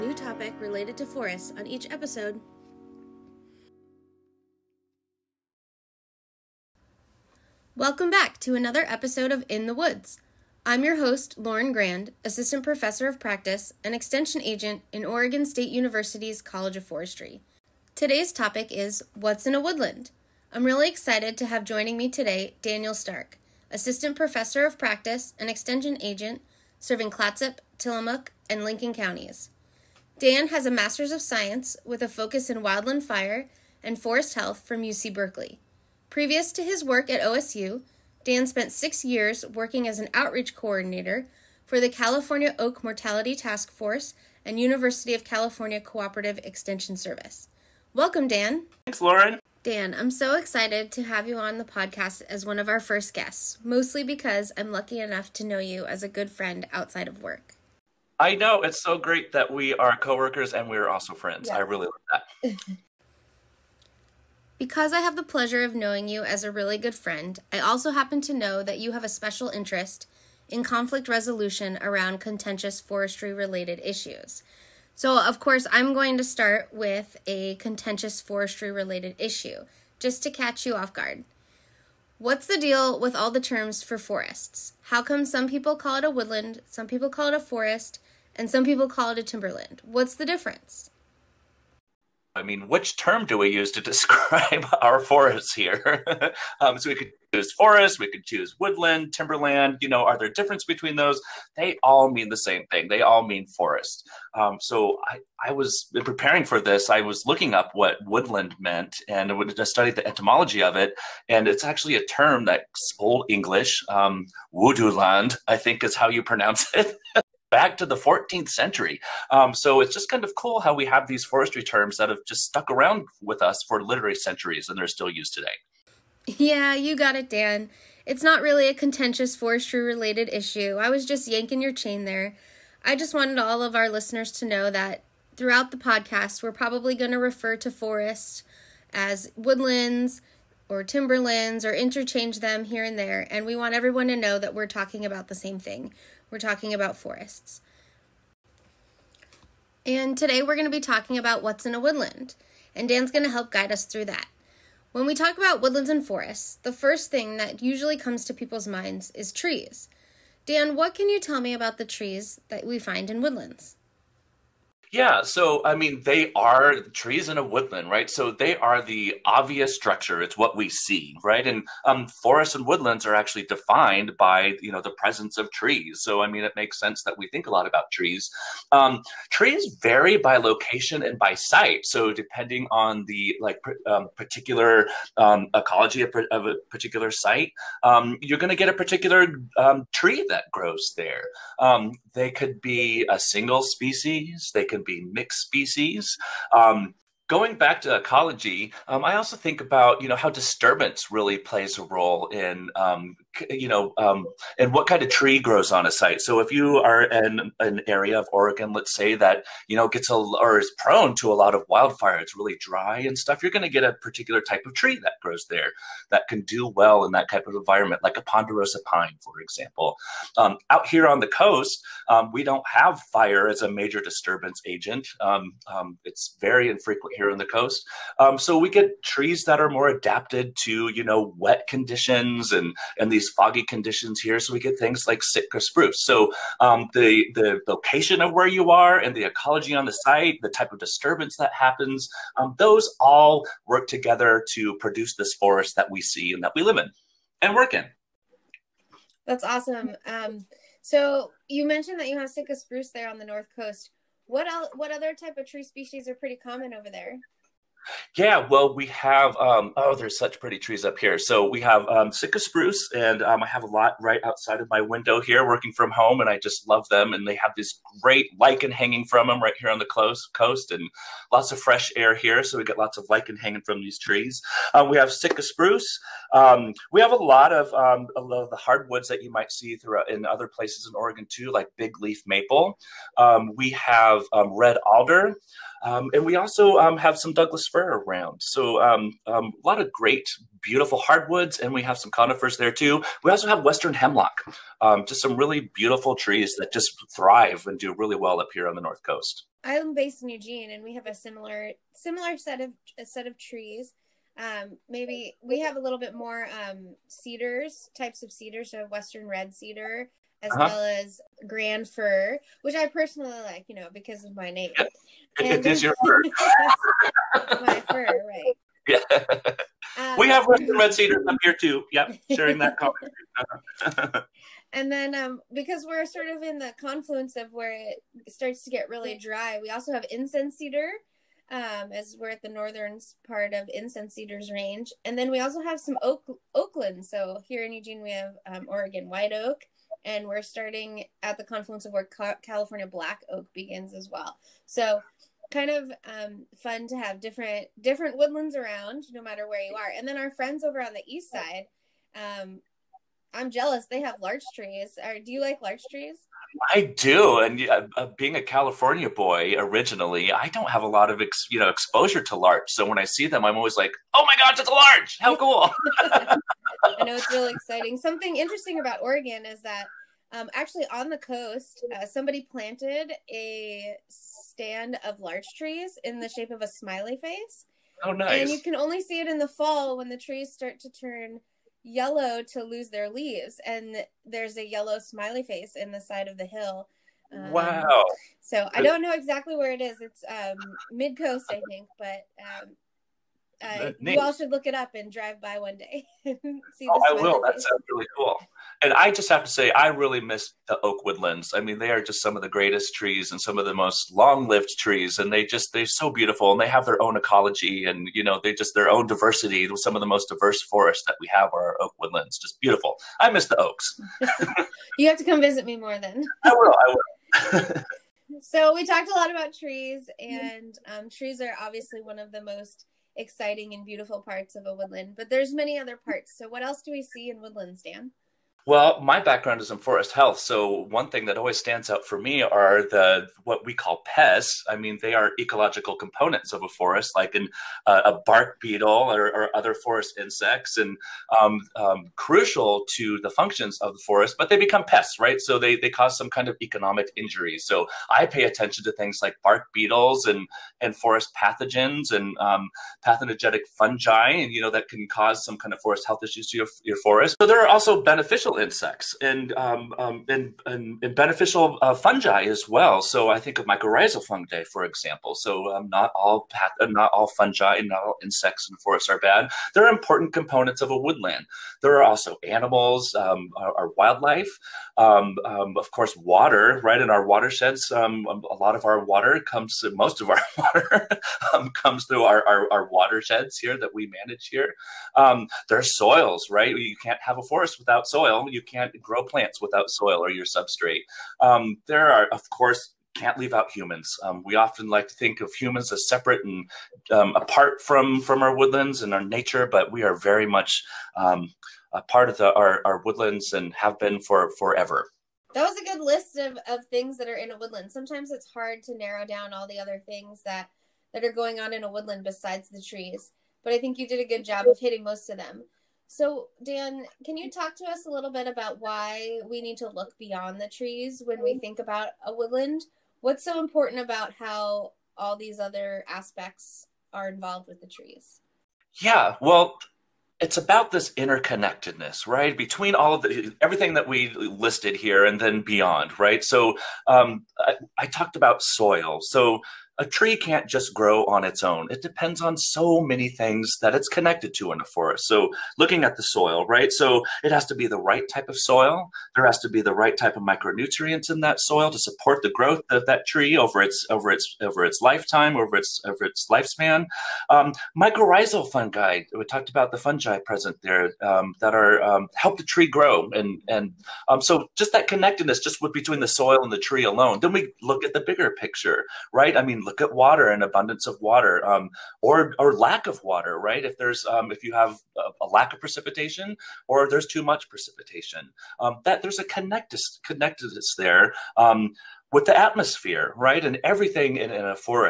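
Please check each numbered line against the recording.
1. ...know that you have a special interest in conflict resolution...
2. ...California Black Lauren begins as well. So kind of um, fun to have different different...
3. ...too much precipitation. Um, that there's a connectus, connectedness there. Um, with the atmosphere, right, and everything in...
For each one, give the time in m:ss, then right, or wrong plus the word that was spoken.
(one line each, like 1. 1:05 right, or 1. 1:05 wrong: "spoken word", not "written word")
1. 1:08 right
2. 5:42 wrong: "Oak", not "Lauren"
3. 9:37 right.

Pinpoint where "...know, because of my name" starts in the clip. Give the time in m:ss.
5:13.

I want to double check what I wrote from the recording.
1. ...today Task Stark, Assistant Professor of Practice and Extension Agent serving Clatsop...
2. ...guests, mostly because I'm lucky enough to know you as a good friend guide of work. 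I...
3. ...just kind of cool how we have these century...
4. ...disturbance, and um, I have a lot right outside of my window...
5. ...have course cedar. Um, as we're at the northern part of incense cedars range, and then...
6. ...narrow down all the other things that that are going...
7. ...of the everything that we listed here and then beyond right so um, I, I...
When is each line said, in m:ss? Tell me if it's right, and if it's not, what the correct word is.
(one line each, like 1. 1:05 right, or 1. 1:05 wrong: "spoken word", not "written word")
1. 0:22 wrong: "Daniel", not "Task"
2. 0:53 wrong: "outside", not "guide"
3. 1:59 wrong: "forestry", not "century"
4. 4:22 wrong: "spruce", not "disturbance"
5. 5:29 wrong: "incense", not "course"
6. 8:28 right
7. 8:53 right.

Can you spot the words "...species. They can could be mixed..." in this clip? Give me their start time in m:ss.
3:13.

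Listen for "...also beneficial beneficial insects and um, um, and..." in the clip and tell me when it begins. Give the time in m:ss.
7:37.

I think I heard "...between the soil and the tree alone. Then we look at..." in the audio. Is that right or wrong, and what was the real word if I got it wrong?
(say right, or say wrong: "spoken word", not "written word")
right.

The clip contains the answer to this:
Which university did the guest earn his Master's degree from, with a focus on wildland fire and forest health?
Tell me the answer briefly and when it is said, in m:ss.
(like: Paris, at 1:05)
UC Berkeley, at 0:34.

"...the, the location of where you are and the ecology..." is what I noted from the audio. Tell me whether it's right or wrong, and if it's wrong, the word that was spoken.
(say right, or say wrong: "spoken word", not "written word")
right.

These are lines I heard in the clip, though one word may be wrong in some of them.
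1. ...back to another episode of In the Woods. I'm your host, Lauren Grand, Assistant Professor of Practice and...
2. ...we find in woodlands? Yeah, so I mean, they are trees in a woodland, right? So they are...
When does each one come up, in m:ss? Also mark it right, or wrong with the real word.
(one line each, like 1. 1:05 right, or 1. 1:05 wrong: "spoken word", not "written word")
1. 0:08 right
2. 2:42 right.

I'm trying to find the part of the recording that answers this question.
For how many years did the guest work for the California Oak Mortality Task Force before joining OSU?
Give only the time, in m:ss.
0:38.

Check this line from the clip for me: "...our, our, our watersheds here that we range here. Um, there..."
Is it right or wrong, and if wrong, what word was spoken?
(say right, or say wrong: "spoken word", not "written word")
wrong: "manage", not "range".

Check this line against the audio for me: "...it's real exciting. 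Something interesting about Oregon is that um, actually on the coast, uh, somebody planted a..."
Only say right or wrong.
right.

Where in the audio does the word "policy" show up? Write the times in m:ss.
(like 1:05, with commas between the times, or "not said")
not said.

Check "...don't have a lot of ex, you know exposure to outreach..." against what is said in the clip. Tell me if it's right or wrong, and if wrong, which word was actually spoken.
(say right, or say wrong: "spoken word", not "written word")
wrong: "larch", not "outreach".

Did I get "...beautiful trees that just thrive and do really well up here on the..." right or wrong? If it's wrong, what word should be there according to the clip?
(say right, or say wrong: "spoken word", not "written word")
right.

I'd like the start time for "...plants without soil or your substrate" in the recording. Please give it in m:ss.
8:09.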